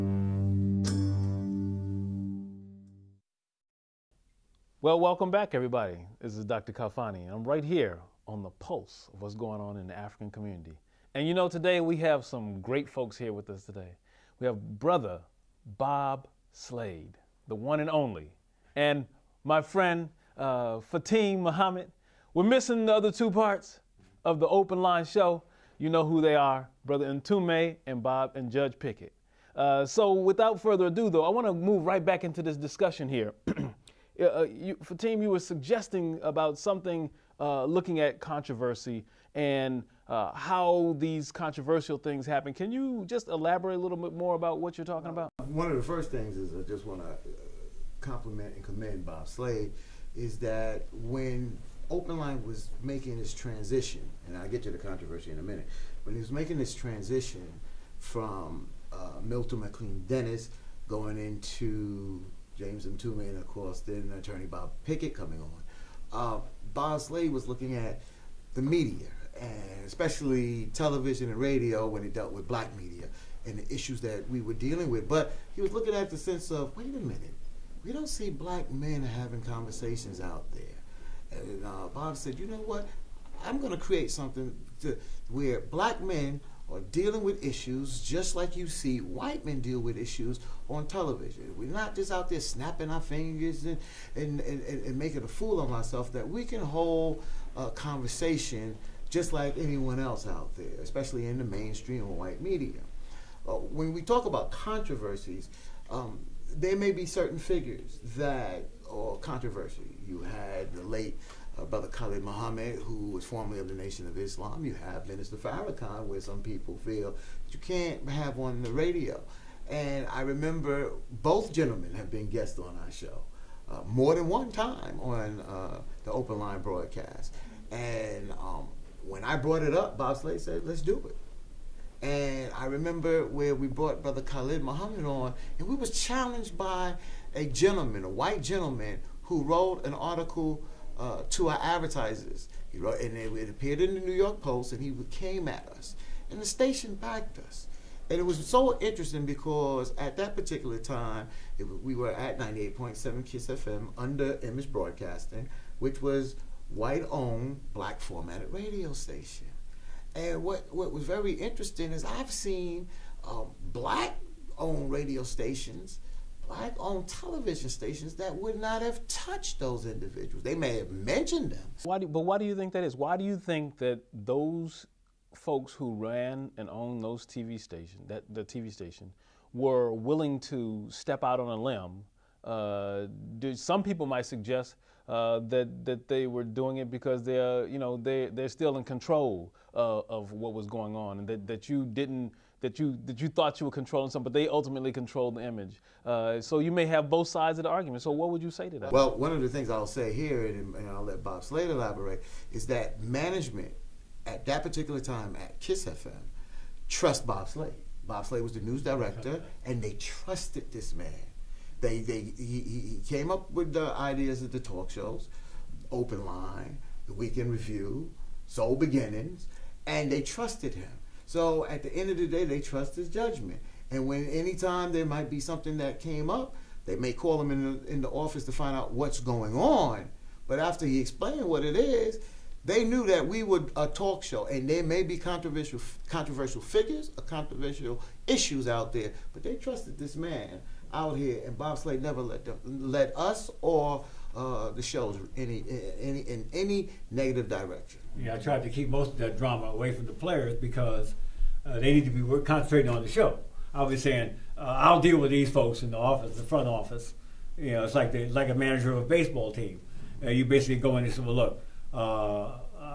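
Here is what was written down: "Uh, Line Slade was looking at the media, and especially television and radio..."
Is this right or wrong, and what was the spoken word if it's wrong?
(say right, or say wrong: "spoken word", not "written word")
wrong: "Bob", not "Line".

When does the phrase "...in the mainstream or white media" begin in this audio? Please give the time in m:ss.
1:41.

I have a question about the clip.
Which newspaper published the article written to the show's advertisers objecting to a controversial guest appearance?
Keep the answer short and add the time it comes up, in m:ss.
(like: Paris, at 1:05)
New York Post, at 2:23.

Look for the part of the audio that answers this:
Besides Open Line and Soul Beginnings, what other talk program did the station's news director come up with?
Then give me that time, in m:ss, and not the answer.
3:37.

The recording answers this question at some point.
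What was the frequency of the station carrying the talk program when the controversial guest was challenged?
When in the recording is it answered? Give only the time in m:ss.
2:32.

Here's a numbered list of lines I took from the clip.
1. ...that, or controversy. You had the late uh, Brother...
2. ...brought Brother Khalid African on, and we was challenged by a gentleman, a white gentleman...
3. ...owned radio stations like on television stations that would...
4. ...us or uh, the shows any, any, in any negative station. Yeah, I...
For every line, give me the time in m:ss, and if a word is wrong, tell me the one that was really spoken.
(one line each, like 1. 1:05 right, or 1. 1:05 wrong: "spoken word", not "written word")
1. 1:48 right
2. 2:13 wrong: "Muhammad", not "African"
3. 2:44 right
4. 4:03 wrong: "direction", not "station".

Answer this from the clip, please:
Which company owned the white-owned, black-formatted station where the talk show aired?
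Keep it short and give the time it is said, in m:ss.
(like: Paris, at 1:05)
Emmis Broadcasting, at 2:34.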